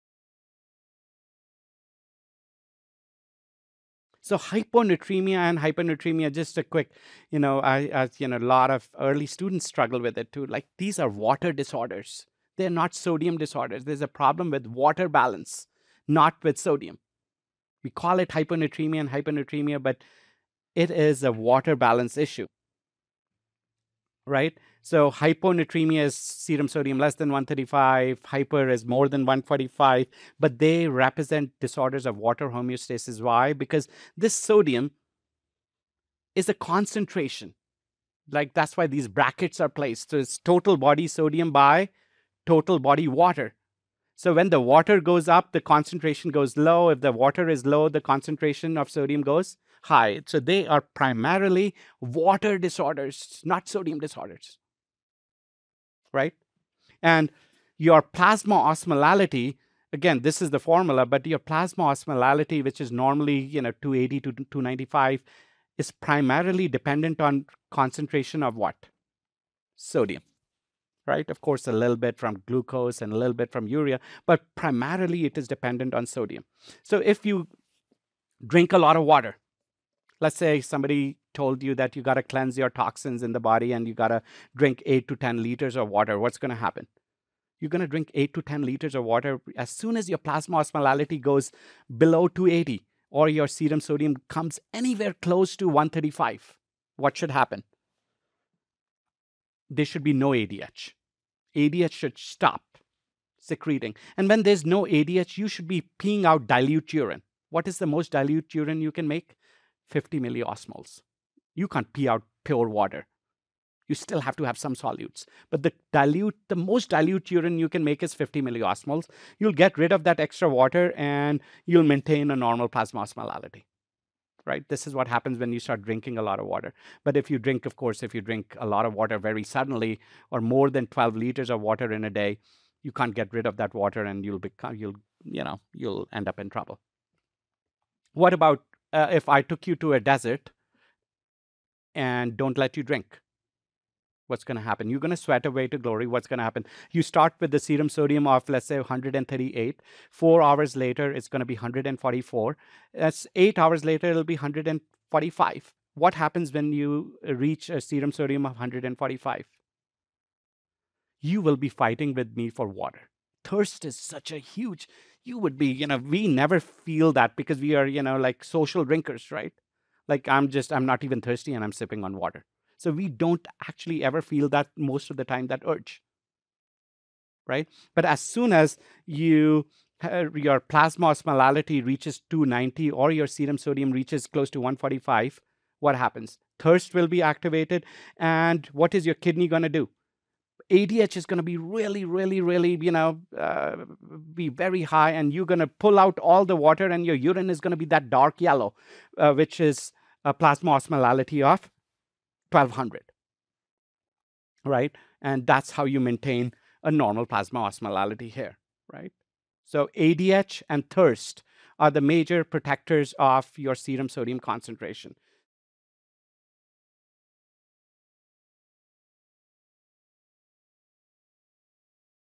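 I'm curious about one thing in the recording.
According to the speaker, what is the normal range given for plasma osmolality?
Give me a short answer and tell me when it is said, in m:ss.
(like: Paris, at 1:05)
280 to 295, at 1:03.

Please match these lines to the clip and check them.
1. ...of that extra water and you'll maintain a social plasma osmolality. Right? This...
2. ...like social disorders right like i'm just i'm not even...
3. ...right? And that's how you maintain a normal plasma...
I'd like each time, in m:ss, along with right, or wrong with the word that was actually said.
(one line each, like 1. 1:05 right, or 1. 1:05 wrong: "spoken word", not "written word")
1. 1:59 wrong: "normal", not "social"
2. 2:48 wrong: "drinkers", not "disorders"
3. 3:24 right.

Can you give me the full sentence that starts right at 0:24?
So hyponatremia is serum sodium less than 135, hyper is more than 145, but they represent disorders of water homeostasis.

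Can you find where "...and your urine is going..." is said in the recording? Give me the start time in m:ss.
3:16.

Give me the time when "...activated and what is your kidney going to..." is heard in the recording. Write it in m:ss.
3:07.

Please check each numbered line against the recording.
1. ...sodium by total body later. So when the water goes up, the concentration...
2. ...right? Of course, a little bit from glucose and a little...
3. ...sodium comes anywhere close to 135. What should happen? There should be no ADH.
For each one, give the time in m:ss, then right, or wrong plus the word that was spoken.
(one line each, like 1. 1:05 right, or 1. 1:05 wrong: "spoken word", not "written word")
1. 0:41 wrong: "water", not "later"
2. 1:11 right
3. 1:33 right.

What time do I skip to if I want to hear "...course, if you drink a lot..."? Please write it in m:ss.
2:07.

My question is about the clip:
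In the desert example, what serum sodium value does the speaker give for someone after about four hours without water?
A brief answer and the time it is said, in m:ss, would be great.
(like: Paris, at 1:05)
144, at 2:31.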